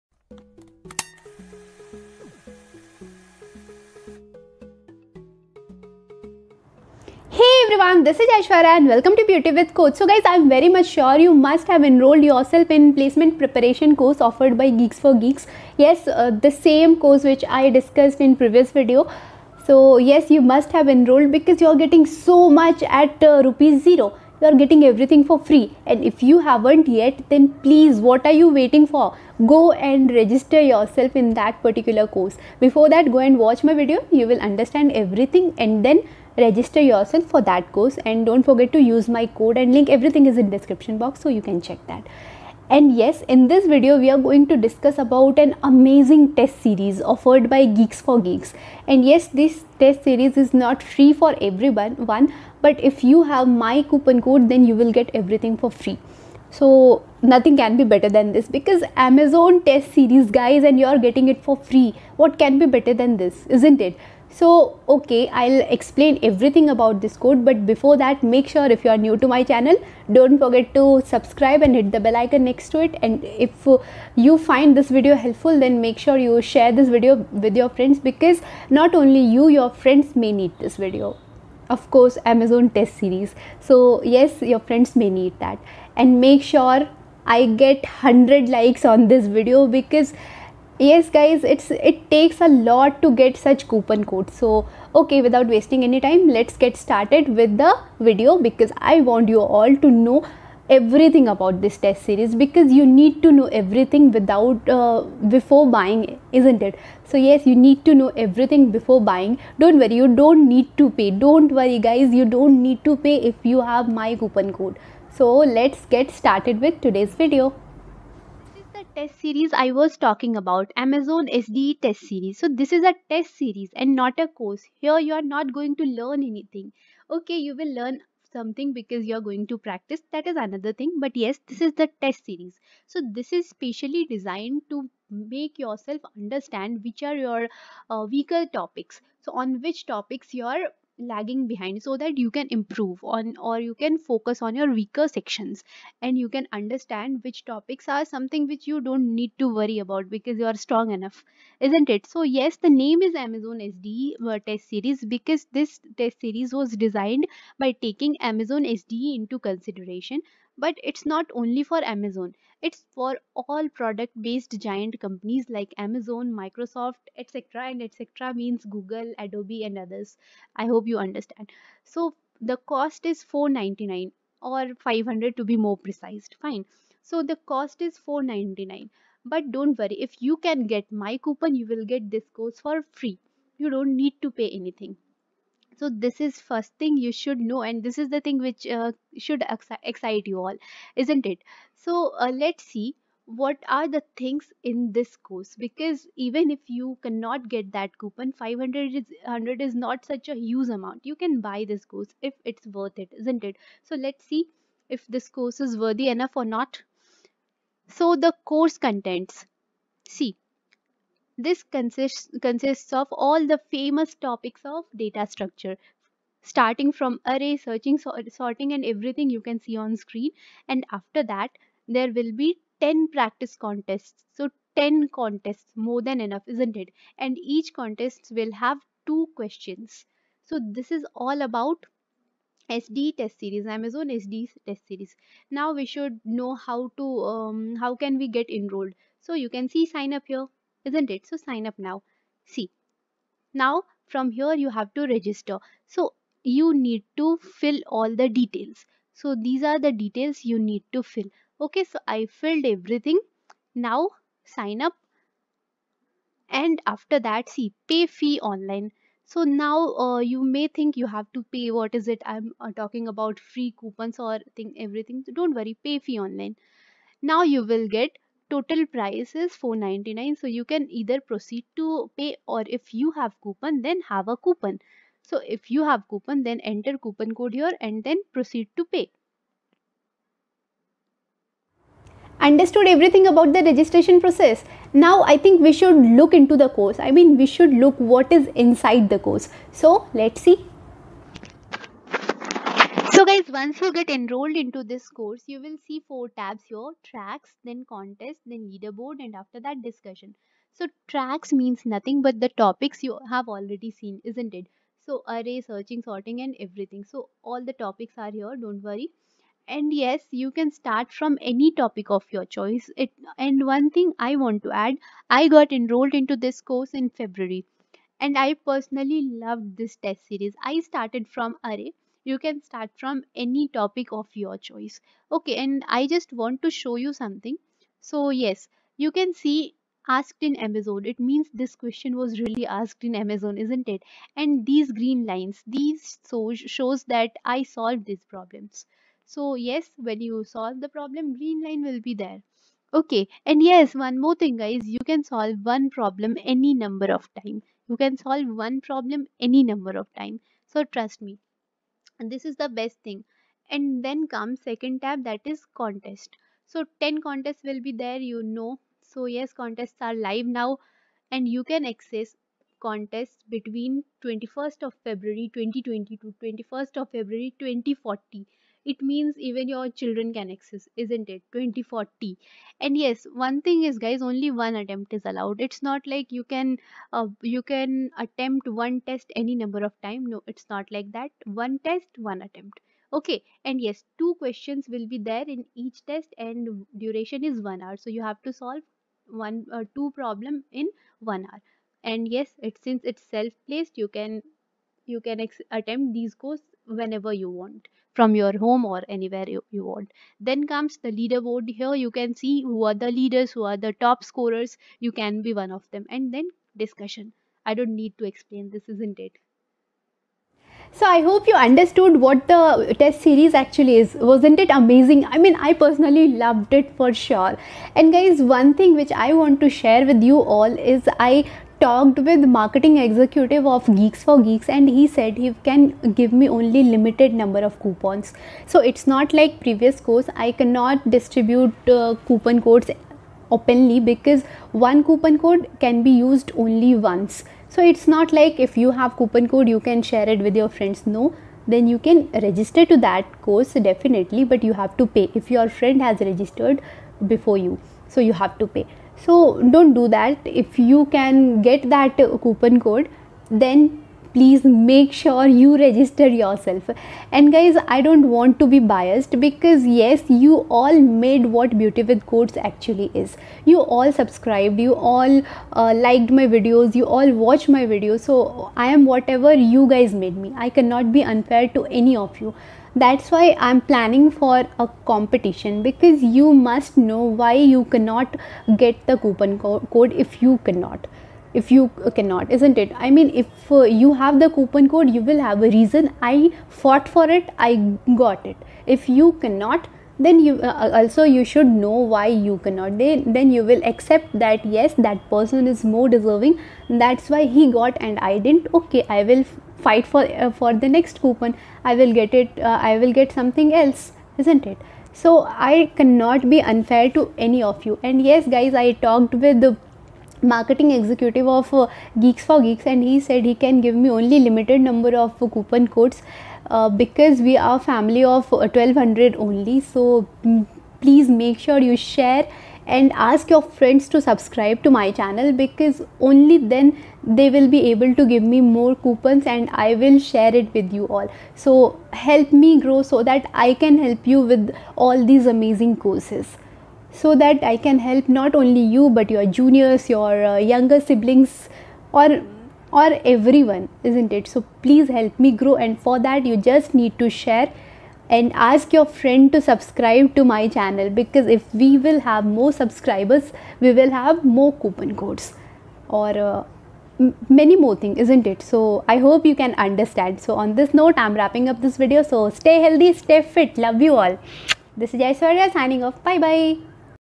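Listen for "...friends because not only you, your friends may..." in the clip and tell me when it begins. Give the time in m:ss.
1:17.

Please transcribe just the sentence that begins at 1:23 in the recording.
So, yes, your friends may need that.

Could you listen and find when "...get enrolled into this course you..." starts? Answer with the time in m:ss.
4:53.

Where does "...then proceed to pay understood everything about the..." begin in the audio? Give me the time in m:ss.
4:38.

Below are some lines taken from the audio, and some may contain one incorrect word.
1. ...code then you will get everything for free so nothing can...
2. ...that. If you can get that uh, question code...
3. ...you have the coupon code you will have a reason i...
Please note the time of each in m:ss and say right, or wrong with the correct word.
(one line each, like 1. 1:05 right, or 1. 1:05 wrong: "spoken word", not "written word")
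1. 0:54 right
2. 7:30 wrong: "coupon", not "question"
3. 8:03 right.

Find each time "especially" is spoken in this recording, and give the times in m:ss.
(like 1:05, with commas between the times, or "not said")
not said.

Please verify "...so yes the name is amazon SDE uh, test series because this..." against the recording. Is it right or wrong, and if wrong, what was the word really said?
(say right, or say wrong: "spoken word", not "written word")
right.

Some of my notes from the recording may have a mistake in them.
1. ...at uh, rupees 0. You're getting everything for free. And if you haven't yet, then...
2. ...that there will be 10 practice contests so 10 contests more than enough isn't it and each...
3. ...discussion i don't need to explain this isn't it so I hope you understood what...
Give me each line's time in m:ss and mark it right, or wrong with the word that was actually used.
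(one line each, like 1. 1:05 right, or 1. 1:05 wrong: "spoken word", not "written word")
1. 0:22 right
2. 3:41 right
3. 6:46 right.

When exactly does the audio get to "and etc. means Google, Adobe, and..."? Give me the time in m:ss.
2:47.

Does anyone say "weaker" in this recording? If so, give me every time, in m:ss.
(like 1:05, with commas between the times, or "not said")
2:18, 2:24.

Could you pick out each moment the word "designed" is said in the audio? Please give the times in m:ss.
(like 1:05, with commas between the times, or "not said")
2:14, 2:36.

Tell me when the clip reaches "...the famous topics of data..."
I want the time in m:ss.
3:33.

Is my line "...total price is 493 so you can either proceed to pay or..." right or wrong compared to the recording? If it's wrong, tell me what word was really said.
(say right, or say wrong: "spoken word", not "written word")
wrong: "499", not "493".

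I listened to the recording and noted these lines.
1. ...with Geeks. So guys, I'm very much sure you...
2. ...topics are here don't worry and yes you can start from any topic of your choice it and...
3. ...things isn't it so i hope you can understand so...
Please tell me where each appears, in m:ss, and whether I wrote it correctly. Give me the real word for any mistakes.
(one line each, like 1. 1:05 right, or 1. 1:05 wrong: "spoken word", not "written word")
1. 0:09 wrong: "Codes", not "Geeks"
2. 5:07 right
3. 9:17 right.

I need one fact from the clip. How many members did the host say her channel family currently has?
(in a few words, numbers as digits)
1200.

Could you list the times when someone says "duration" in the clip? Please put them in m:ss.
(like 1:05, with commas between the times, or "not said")
6:26.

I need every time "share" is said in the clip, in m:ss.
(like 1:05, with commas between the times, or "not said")
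1:16, 6:59, 7:20, 8:41, 8:50, 9:07.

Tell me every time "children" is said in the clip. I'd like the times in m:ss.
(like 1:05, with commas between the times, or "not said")
6:09.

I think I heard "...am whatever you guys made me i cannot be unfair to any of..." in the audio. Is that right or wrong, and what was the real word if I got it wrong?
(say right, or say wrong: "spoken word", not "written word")
right.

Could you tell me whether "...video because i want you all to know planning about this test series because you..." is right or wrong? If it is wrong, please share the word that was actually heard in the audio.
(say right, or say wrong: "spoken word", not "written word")
wrong: "everything", not "planning".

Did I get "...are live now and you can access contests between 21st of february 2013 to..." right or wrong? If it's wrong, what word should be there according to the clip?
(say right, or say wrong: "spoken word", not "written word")
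wrong: "2020", not "2013".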